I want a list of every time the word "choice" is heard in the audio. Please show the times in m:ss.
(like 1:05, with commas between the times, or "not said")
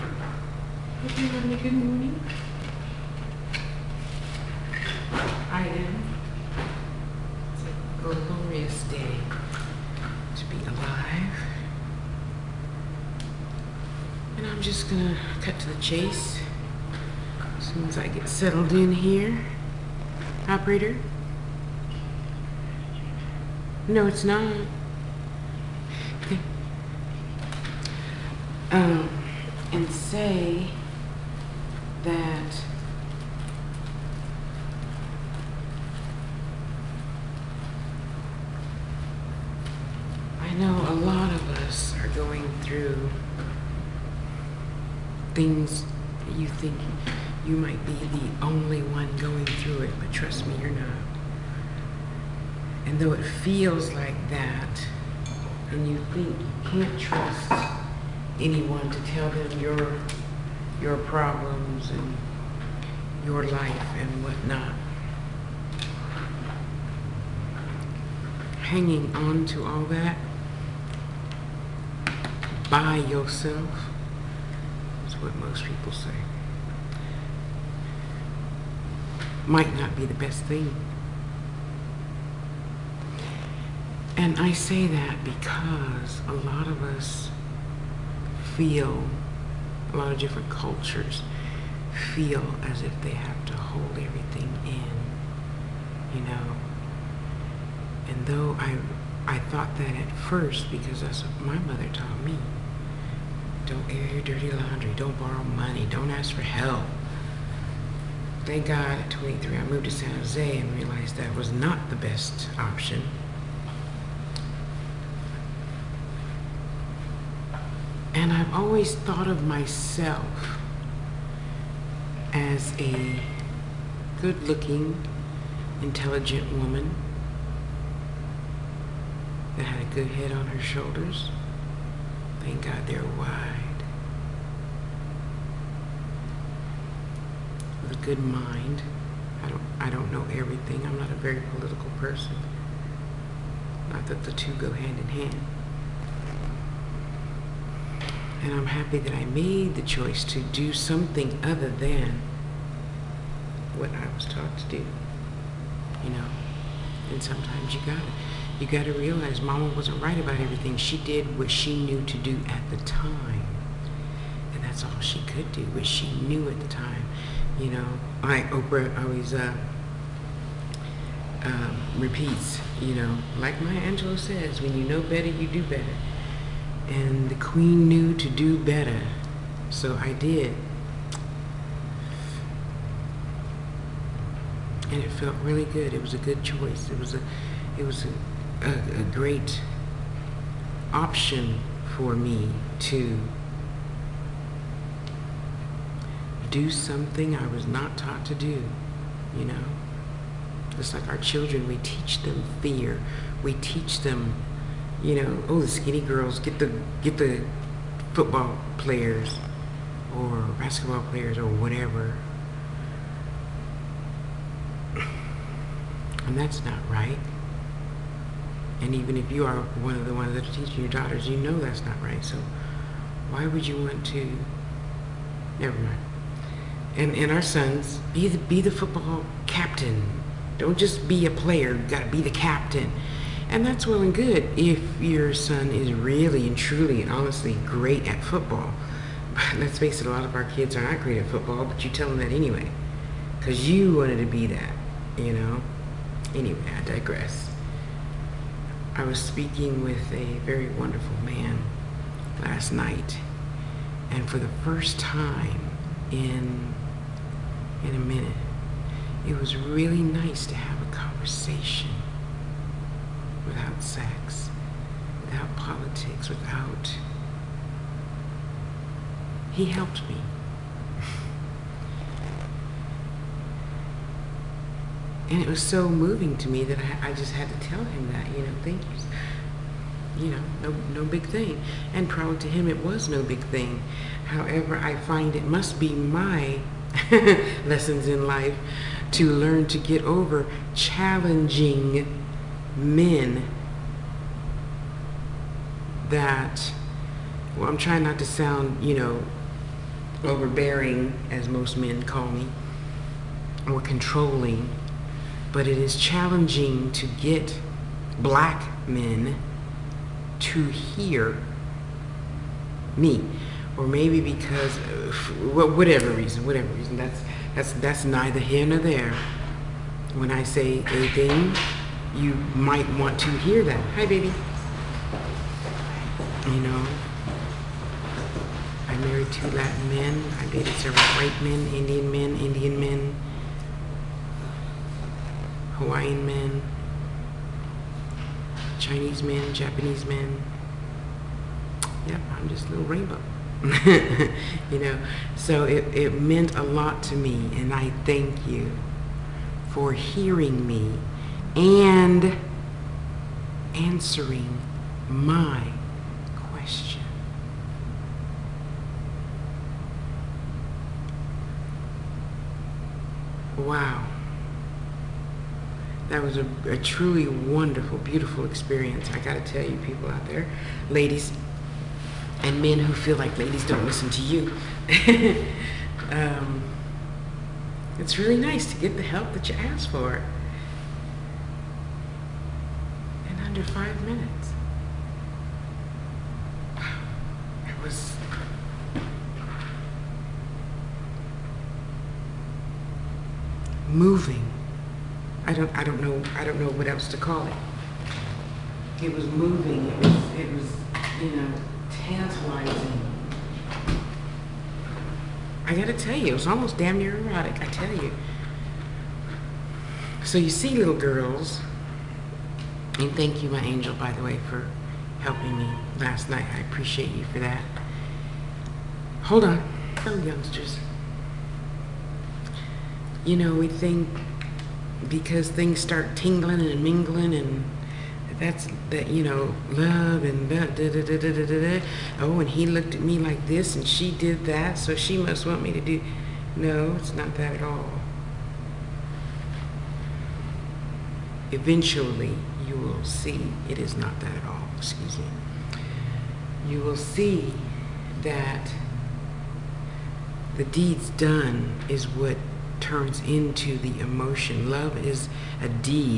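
2:29, 3:06.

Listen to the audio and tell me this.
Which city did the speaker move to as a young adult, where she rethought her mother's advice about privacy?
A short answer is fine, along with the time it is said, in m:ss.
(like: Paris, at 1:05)
San Jose, at 1:49.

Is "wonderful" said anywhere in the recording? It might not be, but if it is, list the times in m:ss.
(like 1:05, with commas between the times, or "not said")
4:10, 6:07.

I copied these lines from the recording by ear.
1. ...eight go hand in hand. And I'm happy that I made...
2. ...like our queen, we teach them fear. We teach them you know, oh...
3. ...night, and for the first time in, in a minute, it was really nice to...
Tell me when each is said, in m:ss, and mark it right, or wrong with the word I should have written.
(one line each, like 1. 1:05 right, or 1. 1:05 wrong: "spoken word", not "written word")
1. 2:24 wrong: "two", not "eight"
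2. 3:20 wrong: "children", not "queen"
3. 4:12 right.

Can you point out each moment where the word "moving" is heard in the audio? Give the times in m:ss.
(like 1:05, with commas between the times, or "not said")
4:35, 6:33, 6:39.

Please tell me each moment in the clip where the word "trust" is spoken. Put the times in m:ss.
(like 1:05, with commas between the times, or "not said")
0:50, 0:56.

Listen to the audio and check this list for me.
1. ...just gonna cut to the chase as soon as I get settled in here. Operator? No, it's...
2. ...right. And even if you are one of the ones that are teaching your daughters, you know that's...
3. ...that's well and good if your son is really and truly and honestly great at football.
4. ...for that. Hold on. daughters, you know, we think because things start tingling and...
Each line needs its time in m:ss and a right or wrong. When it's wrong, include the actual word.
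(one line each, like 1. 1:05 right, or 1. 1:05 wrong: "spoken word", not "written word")
1. 0:14 right
2. 3:36 right
3. 3:53 right
4. 6:57 wrong: "youngsters", not "daughters".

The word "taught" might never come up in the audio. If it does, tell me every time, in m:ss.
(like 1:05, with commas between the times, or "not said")
1:41, 2:34, 3:17.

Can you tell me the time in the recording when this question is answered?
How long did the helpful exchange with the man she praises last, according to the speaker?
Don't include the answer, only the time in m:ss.
6:23.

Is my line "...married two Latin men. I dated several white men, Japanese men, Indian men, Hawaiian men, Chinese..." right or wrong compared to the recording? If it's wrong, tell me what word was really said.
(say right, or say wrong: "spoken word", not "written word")
wrong: "Indian", not "Japanese".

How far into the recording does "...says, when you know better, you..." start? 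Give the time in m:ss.
2:54.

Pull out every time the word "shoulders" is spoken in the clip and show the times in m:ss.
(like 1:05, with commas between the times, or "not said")
2:10.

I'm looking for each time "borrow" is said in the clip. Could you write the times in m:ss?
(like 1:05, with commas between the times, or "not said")
1:45.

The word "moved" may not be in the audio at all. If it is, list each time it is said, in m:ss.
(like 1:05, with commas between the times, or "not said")
1:49.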